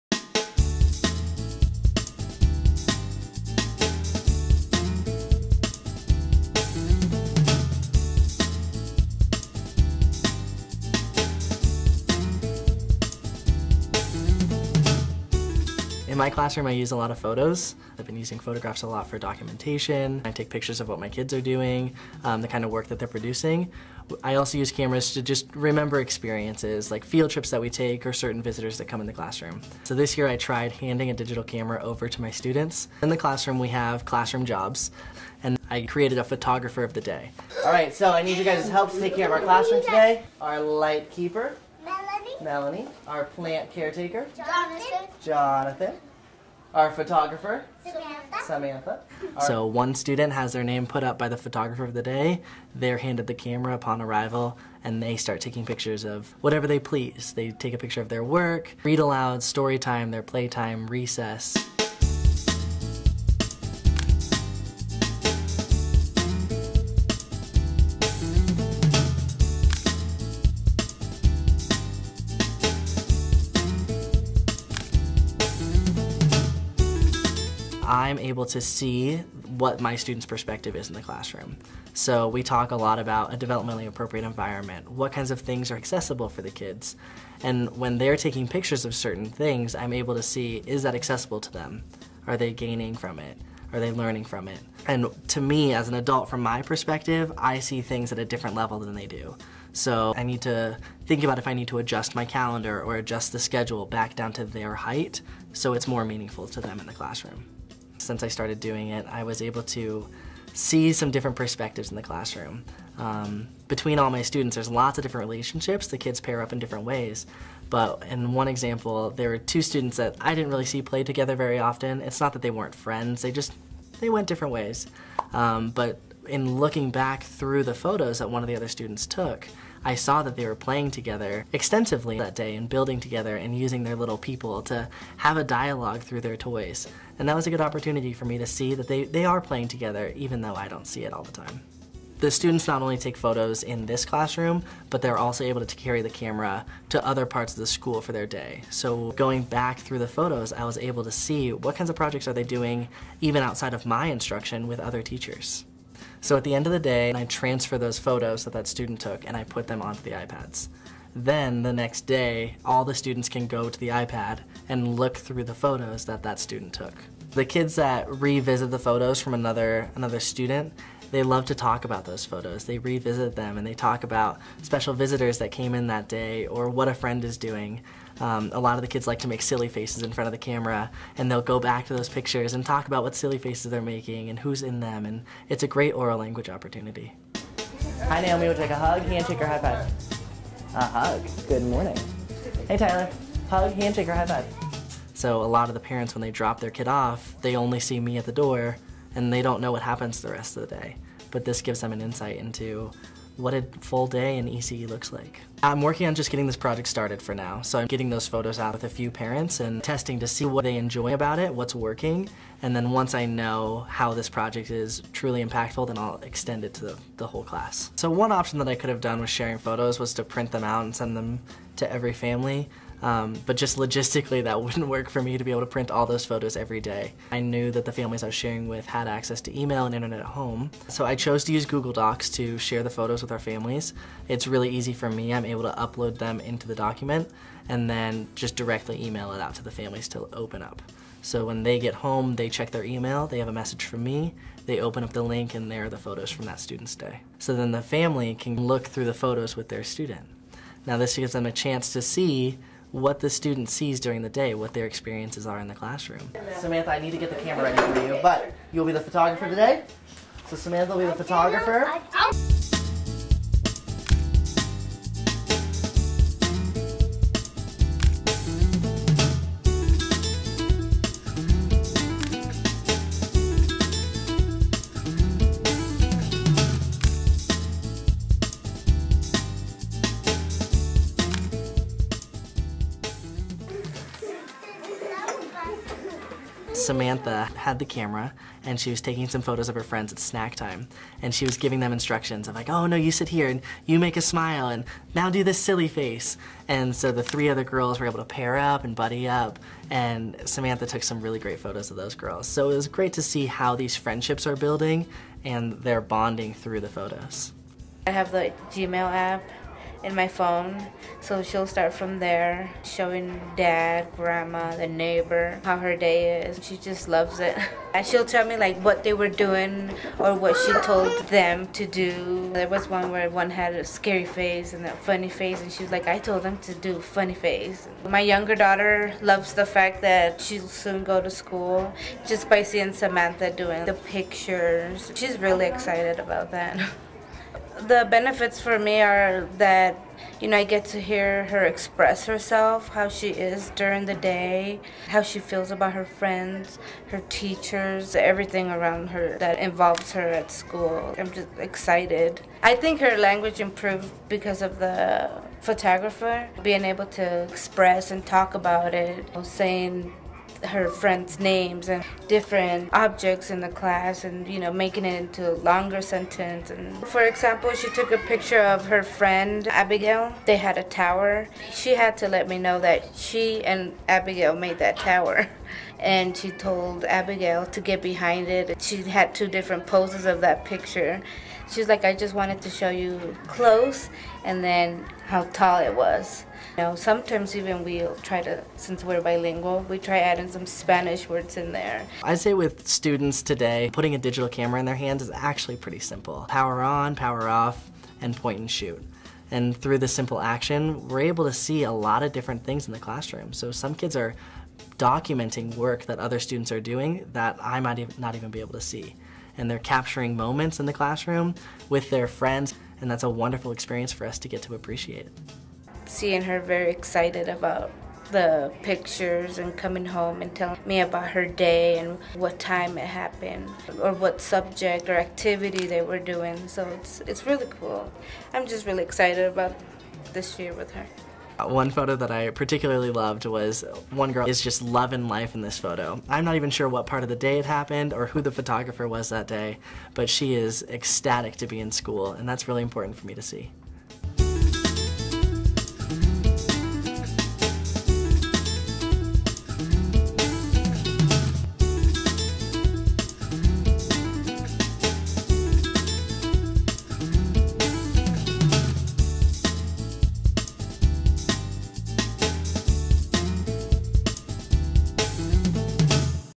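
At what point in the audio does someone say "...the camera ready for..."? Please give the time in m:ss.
4:17.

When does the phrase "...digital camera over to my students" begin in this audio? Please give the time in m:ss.
0:31.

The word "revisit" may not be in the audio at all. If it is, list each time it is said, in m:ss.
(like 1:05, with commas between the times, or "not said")
2:48, 2:52.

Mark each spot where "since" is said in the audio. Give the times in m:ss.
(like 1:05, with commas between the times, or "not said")
1:48, 6:28.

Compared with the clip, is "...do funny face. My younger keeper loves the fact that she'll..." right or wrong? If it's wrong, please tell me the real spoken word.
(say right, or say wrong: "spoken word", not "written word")
wrong: "daughter", not "keeper".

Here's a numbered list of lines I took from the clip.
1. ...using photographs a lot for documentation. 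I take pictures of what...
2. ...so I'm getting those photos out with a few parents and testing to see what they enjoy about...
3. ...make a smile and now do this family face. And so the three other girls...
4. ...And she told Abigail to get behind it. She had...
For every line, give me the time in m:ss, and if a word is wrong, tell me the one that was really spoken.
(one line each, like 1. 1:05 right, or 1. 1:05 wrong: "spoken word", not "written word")
1. 0:18 right
2. 3:27 right
3. 4:53 wrong: "silly", not "family"
4. 6:16 right.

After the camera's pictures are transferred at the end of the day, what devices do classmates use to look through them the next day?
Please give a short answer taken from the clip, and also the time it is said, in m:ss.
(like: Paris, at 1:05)
iPads, at 2:40.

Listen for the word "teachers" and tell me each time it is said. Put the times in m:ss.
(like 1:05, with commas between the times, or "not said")
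2:35, 5:47.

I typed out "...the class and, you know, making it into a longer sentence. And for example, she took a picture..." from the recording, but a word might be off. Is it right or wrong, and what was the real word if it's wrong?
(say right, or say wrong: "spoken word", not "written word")
right.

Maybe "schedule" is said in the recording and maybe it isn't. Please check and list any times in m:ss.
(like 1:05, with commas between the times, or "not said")
1:43.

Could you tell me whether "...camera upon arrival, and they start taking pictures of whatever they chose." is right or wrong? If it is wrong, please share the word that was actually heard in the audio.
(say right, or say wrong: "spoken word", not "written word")
wrong: "please", not "chose".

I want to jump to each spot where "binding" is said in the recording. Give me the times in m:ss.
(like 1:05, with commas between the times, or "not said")
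not said.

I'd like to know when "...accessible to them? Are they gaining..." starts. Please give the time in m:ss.
1:30.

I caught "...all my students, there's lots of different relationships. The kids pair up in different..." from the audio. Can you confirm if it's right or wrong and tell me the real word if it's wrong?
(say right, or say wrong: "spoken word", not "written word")
right.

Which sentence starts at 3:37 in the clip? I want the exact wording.
So one option that I could have done with sharing photos was to print them out and send them to every family.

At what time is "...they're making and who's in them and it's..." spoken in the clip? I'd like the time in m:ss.
3:03.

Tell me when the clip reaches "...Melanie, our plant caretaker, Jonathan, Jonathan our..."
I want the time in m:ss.
0:42.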